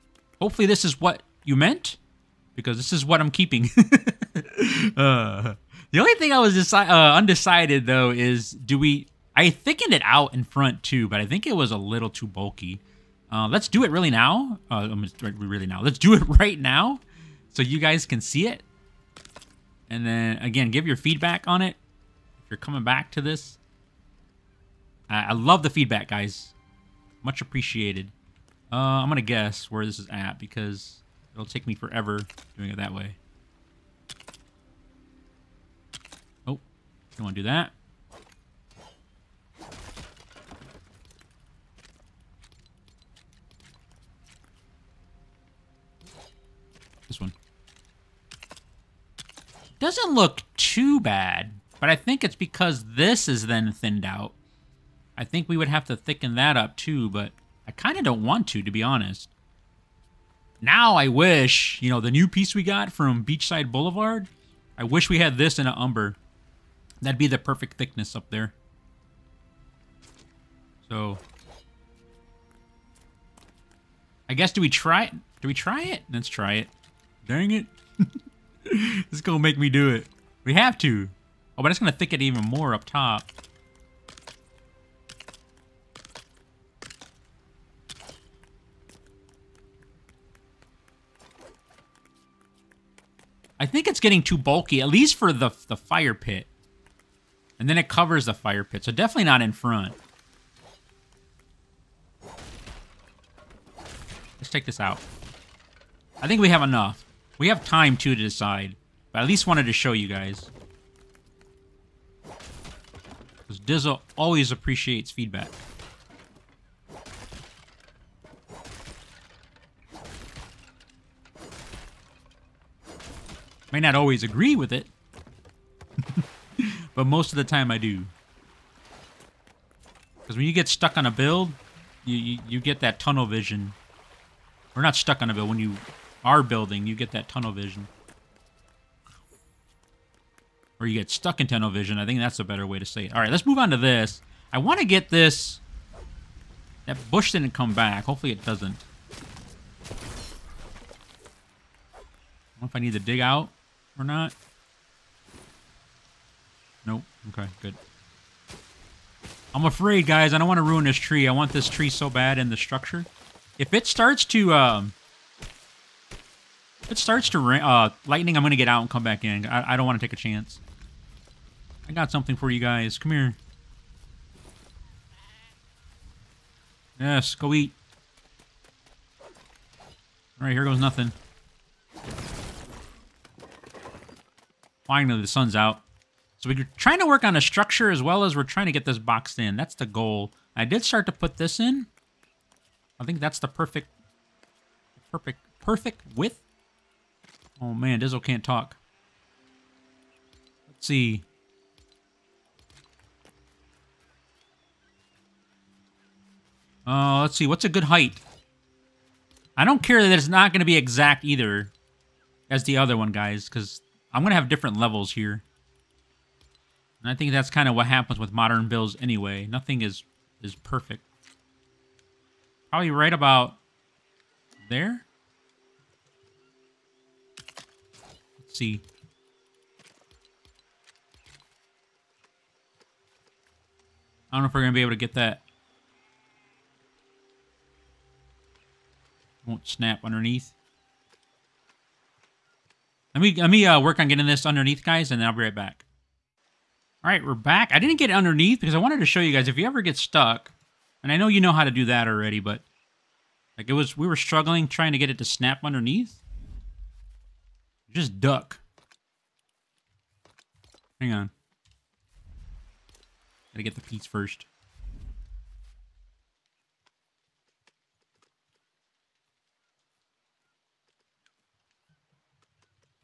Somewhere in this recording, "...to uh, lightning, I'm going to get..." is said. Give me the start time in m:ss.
2:47.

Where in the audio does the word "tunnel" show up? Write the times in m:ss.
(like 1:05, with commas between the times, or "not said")
2:12, 2:17, 2:21.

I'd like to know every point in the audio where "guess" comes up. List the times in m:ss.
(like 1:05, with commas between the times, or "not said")
0:29, 1:14.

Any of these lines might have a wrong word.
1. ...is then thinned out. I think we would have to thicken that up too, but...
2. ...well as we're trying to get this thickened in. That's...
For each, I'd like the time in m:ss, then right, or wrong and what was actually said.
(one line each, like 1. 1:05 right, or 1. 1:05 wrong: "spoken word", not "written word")
1. 0:53 right
2. 3:08 wrong: "boxed", not "thickened".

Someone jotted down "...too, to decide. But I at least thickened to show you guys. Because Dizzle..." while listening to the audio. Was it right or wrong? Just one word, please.
wrong.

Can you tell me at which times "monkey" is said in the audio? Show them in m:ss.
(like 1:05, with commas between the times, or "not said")
not said.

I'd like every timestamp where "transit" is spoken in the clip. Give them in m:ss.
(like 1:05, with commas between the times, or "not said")
not said.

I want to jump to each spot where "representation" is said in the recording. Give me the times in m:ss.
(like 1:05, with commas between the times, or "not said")
not said.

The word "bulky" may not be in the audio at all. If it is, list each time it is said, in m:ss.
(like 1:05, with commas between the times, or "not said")
0:12, 1:34.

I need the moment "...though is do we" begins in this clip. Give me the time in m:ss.
0:07.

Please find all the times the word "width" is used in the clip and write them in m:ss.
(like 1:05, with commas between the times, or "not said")
3:16.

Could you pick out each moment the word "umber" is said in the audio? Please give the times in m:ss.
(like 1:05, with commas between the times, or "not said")
1:05.